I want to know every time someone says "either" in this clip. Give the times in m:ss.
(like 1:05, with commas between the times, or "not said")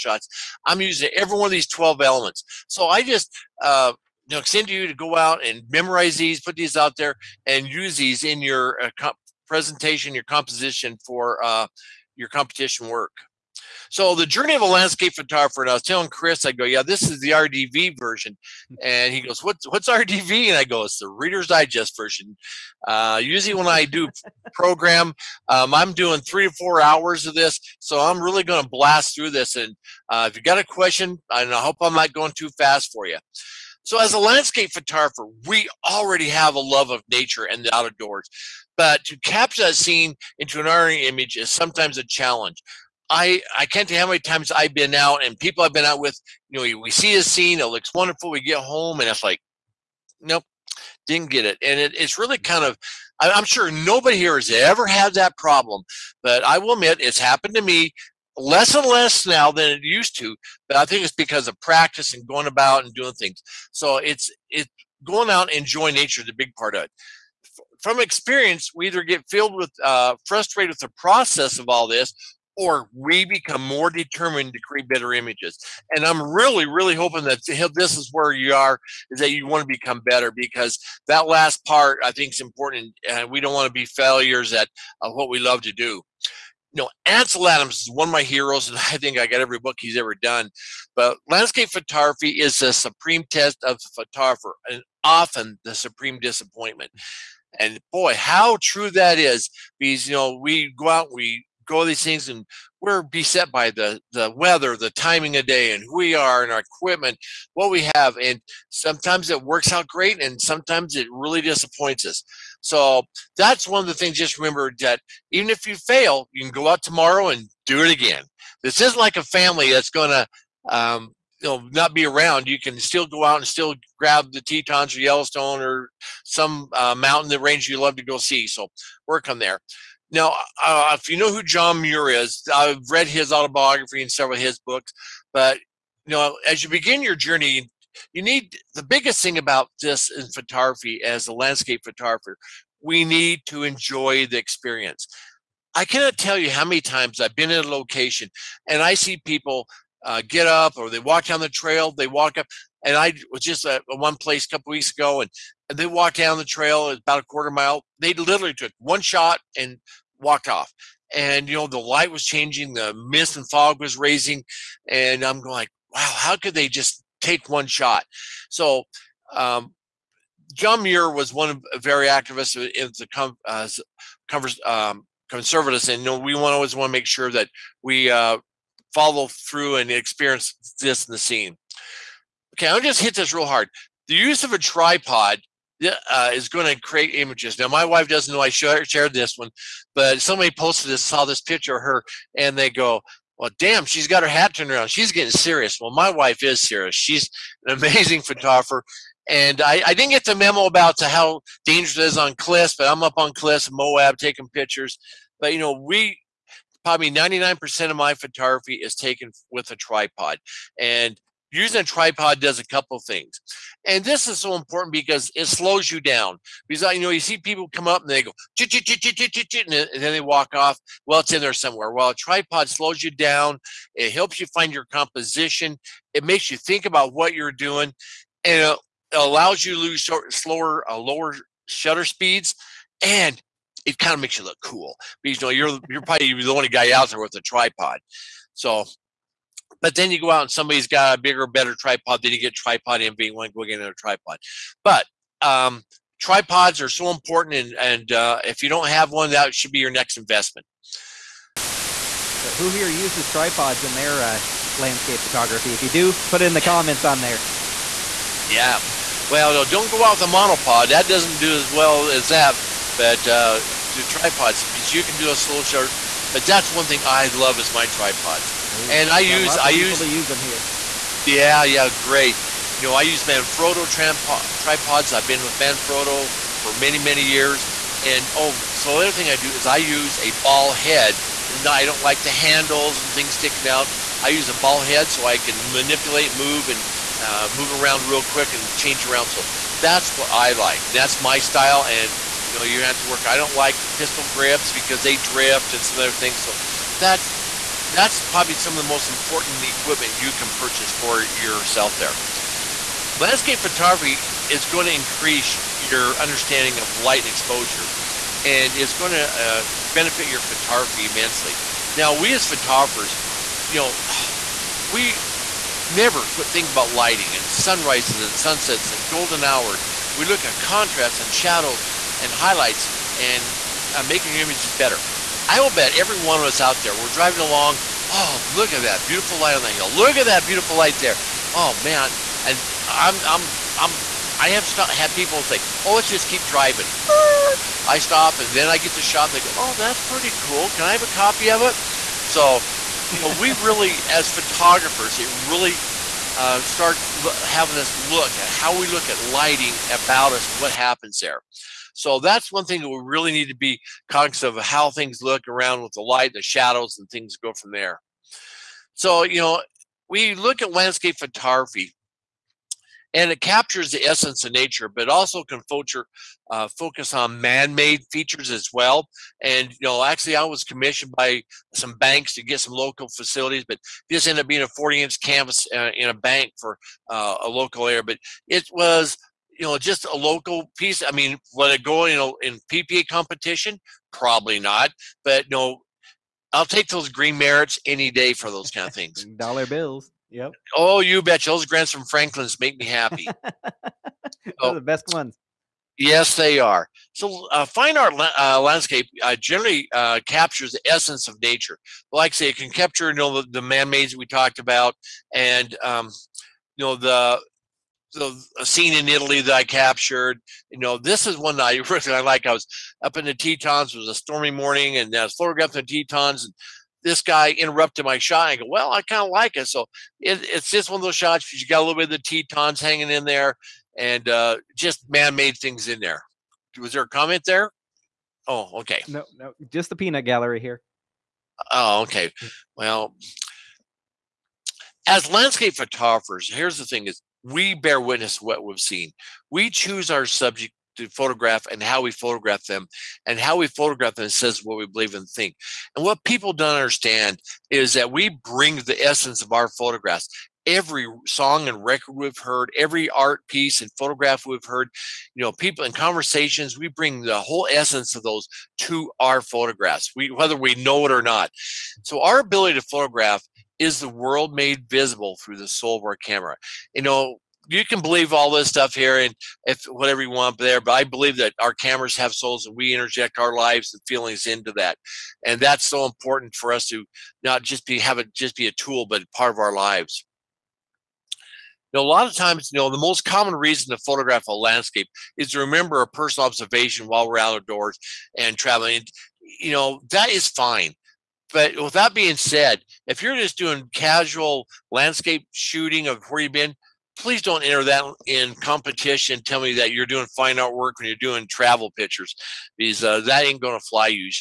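1:08.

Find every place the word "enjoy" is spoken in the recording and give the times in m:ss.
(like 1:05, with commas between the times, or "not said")
1:05, 2:23.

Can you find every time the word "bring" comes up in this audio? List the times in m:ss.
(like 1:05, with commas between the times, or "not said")
7:28, 7:36.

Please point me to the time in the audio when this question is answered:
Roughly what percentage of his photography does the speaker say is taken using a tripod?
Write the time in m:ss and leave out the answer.
3:27.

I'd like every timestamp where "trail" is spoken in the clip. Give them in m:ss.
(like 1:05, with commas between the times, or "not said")
2:31, 2:36.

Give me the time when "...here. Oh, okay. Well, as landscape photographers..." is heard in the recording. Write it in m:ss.
7:10.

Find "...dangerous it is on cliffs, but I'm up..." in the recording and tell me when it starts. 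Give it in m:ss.
3:21.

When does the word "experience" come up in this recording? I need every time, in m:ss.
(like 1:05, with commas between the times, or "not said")
1:07, 2:24, 2:59.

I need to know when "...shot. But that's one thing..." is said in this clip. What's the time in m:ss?
4:25.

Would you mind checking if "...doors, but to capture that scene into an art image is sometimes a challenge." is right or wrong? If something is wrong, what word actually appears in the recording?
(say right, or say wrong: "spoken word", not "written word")
wrong: "outdoors", not "doors".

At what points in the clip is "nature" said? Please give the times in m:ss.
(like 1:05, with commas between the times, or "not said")
0:37, 1:05, 6:04, 6:41.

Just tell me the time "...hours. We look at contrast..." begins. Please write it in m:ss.
5:19.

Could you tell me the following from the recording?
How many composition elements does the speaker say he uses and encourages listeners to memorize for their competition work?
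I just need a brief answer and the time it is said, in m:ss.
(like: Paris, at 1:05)
12, at 0:01.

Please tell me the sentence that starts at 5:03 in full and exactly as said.
Landscape photography it's going to increase your understanding of light and exposure, and it's going to uh, benefit your photography immensely.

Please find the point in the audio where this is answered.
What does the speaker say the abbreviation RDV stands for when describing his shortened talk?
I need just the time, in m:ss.
0:21.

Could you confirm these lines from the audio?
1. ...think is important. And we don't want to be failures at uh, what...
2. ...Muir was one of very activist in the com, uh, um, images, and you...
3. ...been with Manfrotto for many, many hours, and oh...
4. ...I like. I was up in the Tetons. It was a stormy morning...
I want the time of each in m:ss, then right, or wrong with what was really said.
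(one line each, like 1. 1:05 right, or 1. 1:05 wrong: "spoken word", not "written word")
1. 1:22 right
2. 2:50 wrong: "conservatives", not "images"
3. 4:35 wrong: "years", not "hours"
4. 6:52 right.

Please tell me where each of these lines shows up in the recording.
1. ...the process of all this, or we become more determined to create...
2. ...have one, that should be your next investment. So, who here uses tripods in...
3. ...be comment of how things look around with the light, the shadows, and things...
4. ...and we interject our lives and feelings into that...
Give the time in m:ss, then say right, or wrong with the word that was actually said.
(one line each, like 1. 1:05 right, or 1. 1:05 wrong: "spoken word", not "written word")
1. 1:10 right
2. 4:08 right
3. 5:53 wrong: "cognizant", not "comment"
4. 7:52 right.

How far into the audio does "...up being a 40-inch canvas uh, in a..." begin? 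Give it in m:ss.
6:14.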